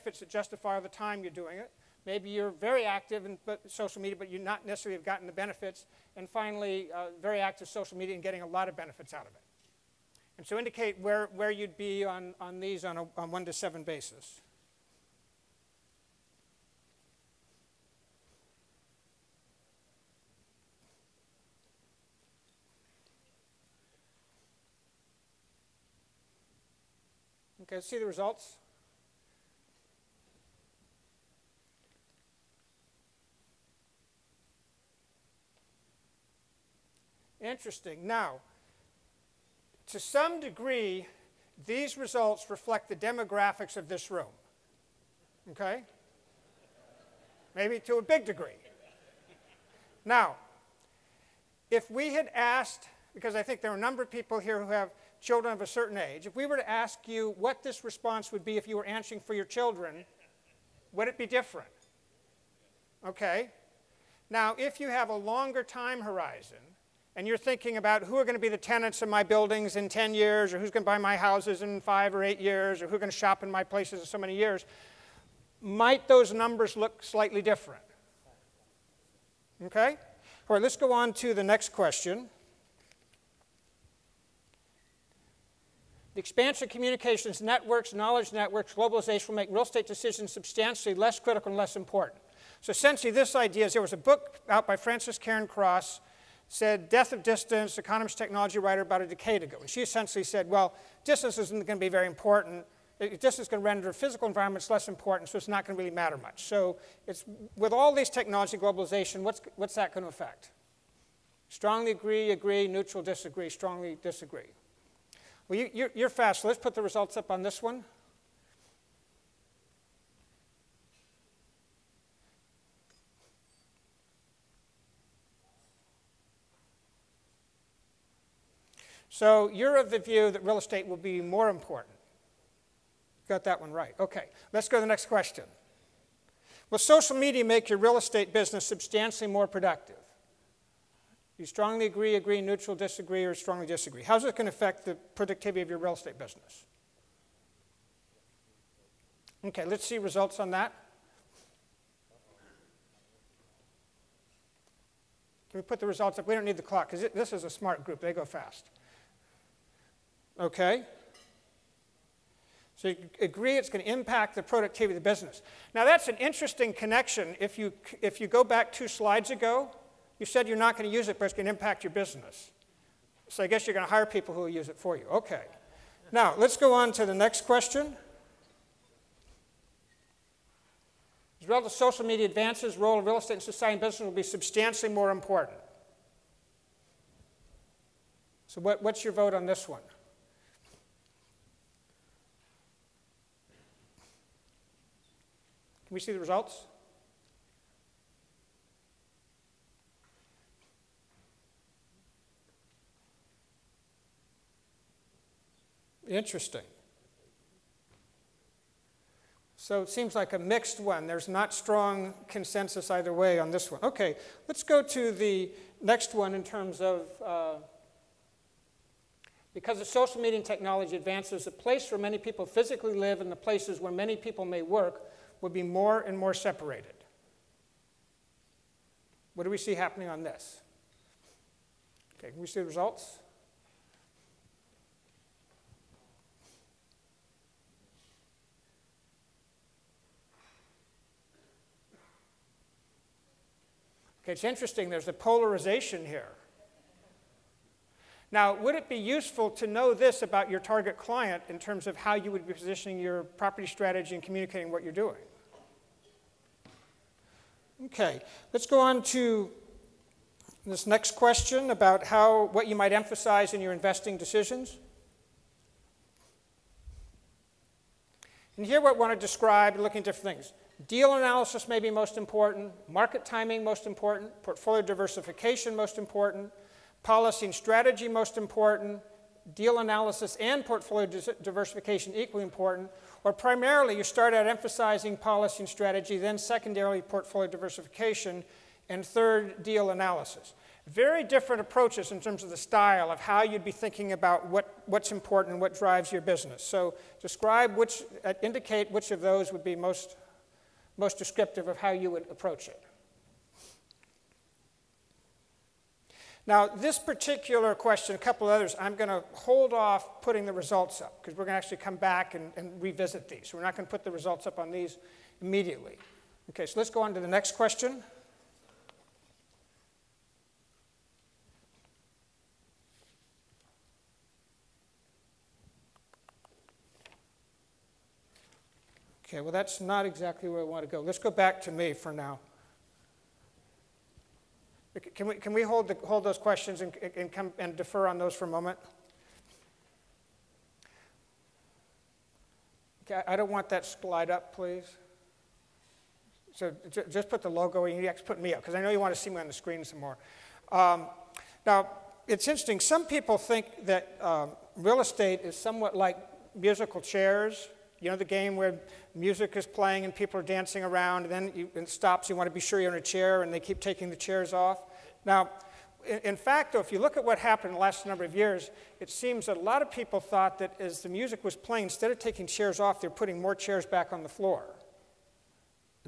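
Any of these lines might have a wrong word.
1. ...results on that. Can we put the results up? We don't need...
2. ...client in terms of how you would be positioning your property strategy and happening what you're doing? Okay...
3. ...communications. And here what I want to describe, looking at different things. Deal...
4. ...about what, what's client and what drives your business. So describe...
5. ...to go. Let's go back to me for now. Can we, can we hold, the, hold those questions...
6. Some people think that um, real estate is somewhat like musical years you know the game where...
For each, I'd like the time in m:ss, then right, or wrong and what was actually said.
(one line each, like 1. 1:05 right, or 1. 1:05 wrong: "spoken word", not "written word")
1. 2:29 right
2. 4:10 wrong: "communicating", not "happening"
3. 4:24 wrong: "decisions", not "communications"
4. 4:54 wrong: "important", not "client"
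5. 5:30 right
6. 5:52 wrong: "chairs", not "years".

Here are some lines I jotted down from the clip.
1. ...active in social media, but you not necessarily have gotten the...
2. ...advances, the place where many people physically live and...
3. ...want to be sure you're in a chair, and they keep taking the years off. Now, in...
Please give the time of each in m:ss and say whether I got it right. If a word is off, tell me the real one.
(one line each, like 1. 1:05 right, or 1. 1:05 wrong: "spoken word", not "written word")
1. 0:02 right
2. 3:40 right
3. 6:02 wrong: "chairs", not "years".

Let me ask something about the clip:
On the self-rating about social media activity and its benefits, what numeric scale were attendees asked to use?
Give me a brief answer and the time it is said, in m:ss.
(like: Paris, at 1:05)
1 to 7, at 0:13.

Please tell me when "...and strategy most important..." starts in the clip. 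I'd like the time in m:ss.
4:37.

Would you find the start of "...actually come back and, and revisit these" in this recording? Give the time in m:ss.
5:11.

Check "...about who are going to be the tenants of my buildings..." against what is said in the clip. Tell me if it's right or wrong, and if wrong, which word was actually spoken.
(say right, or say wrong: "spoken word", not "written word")
right.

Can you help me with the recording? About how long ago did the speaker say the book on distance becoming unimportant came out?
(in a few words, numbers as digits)
a decade ago.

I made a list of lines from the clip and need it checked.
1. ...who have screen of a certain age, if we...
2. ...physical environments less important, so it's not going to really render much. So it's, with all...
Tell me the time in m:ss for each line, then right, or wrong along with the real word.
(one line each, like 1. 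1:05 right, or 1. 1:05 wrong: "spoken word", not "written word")
1. 0:54 wrong: "children", not "screen"
2. 1:43 wrong: "matter", not "render".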